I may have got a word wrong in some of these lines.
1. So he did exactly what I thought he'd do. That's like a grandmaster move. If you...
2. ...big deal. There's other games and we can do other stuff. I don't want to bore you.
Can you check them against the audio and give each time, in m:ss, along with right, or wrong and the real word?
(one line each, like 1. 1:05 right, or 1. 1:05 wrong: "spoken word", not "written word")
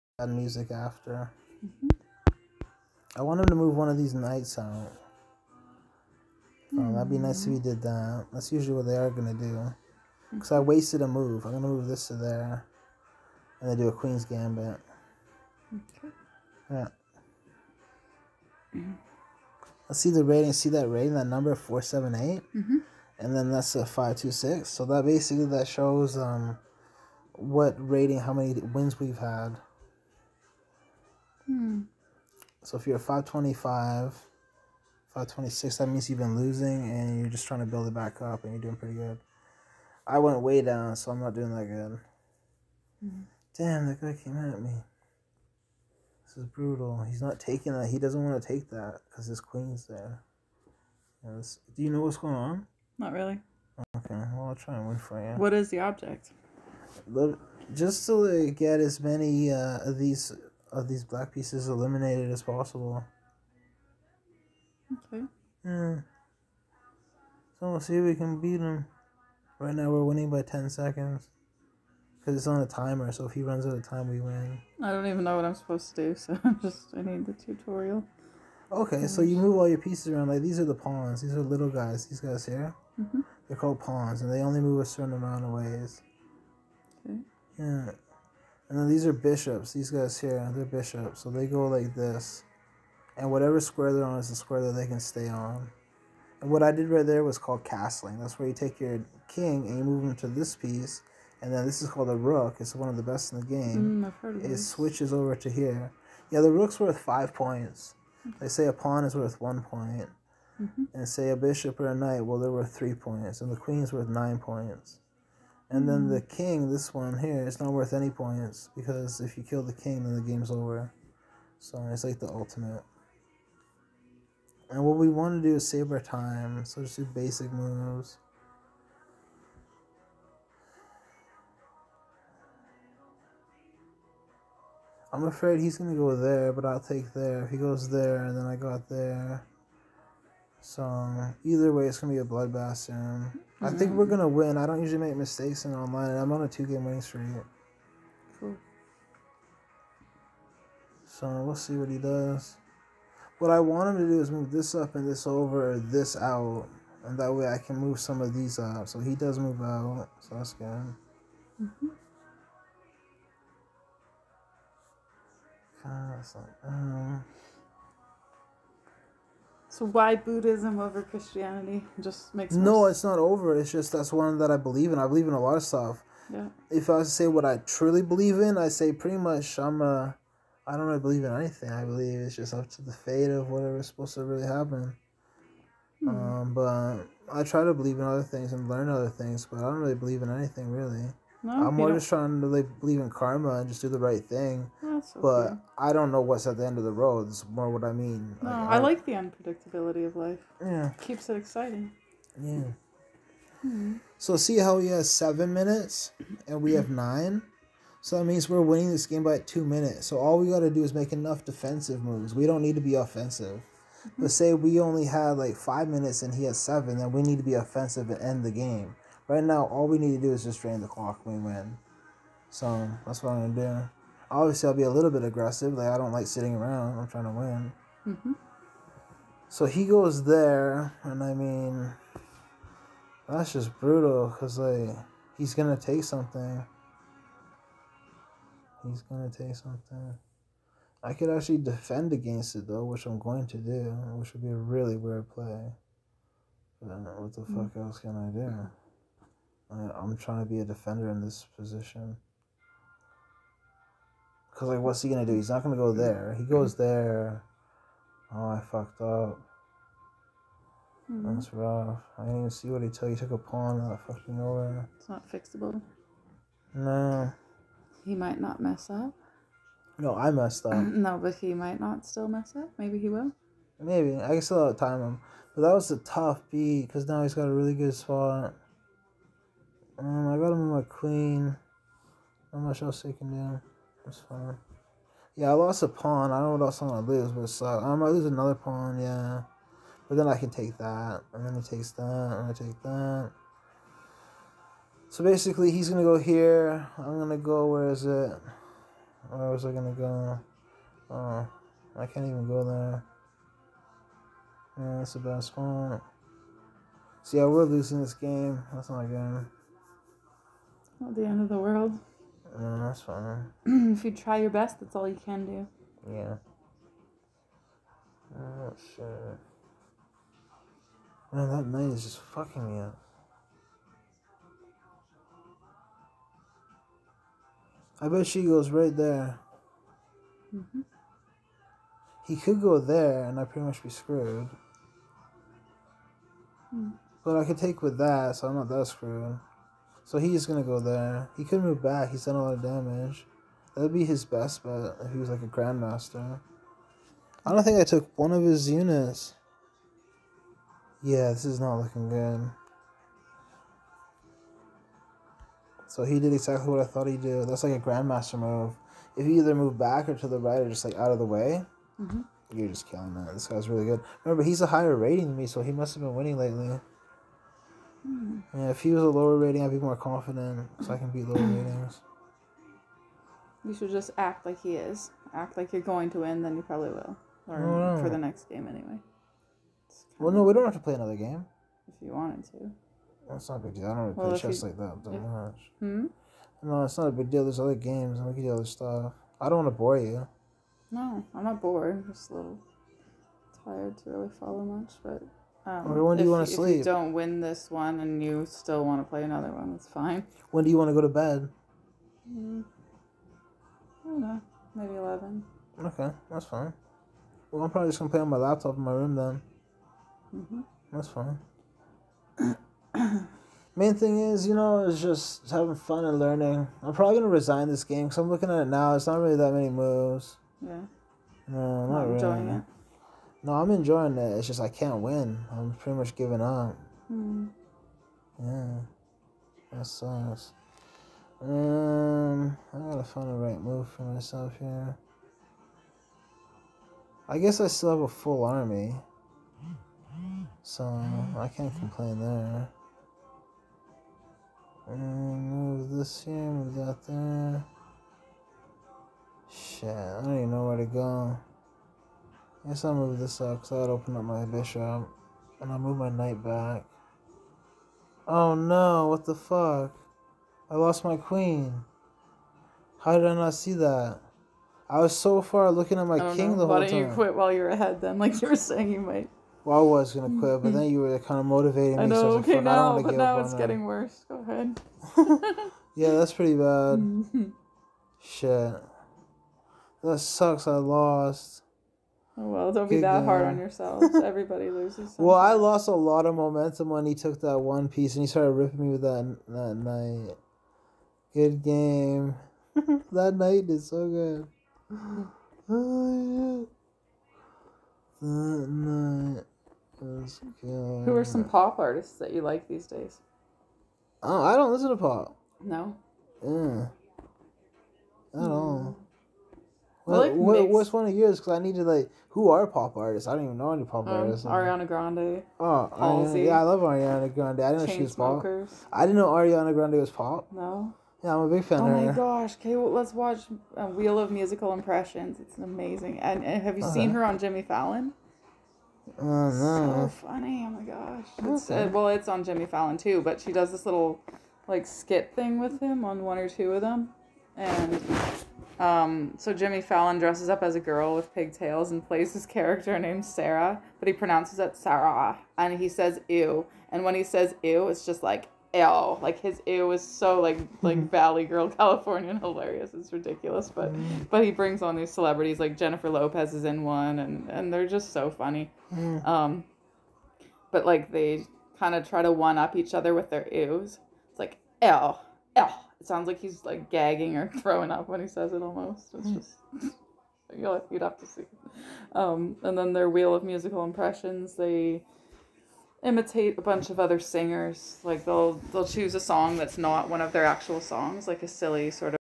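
1. 5:55 right
2. 6:27 right.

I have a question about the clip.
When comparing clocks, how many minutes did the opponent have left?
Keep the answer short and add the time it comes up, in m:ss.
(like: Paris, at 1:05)
7, at 3:25.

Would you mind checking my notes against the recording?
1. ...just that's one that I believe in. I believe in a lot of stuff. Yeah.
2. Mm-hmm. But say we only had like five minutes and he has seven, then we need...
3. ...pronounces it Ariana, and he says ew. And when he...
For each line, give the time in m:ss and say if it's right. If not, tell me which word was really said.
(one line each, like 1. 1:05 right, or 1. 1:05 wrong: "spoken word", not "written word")
1. 2:53 right
2. 3:33 right
3. 9:04 wrong: "Sarah", not "Ariana".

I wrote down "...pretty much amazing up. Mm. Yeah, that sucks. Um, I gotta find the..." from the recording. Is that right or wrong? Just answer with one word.
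wrong.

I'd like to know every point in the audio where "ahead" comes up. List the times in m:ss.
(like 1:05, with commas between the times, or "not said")
7:47, 7:54.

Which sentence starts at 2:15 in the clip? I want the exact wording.
I'm afraid he's gonna go there, but I'll take there.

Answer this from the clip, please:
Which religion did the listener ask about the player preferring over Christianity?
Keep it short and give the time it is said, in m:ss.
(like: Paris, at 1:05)
Buddhism, at 2:50.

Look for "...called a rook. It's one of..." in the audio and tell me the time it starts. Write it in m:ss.
1:41.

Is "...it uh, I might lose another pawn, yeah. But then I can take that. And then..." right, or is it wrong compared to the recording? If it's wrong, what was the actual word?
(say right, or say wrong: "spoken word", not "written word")
right.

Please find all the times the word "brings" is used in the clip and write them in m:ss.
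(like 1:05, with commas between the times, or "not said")
9:14.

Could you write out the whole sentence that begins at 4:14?
Because, like, what's he going to do?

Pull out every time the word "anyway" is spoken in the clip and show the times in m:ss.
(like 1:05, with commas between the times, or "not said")
6:18.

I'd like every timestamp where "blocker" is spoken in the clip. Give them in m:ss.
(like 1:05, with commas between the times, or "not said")
not said.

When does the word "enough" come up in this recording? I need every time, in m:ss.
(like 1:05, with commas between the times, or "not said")
3:31.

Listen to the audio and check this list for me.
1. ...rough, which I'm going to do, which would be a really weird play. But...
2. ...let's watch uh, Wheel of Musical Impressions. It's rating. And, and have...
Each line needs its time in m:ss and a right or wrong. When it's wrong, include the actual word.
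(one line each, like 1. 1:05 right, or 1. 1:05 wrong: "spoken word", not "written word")
1. 4:02 wrong: "though", not "rough"
2. 8:42 wrong: "amazing", not "rating".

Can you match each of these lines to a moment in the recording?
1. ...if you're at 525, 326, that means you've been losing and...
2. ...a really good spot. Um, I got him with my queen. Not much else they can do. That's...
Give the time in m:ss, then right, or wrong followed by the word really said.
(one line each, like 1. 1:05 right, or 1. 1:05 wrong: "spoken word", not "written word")
1. 0:32 wrong: "526", not "326"
2. 4:37 right.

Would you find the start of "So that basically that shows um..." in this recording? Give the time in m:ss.
0:24.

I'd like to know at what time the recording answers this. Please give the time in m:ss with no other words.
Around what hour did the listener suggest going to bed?
6:44.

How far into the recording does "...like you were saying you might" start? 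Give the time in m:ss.
7:48.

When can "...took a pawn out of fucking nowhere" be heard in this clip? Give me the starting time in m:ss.
4:23.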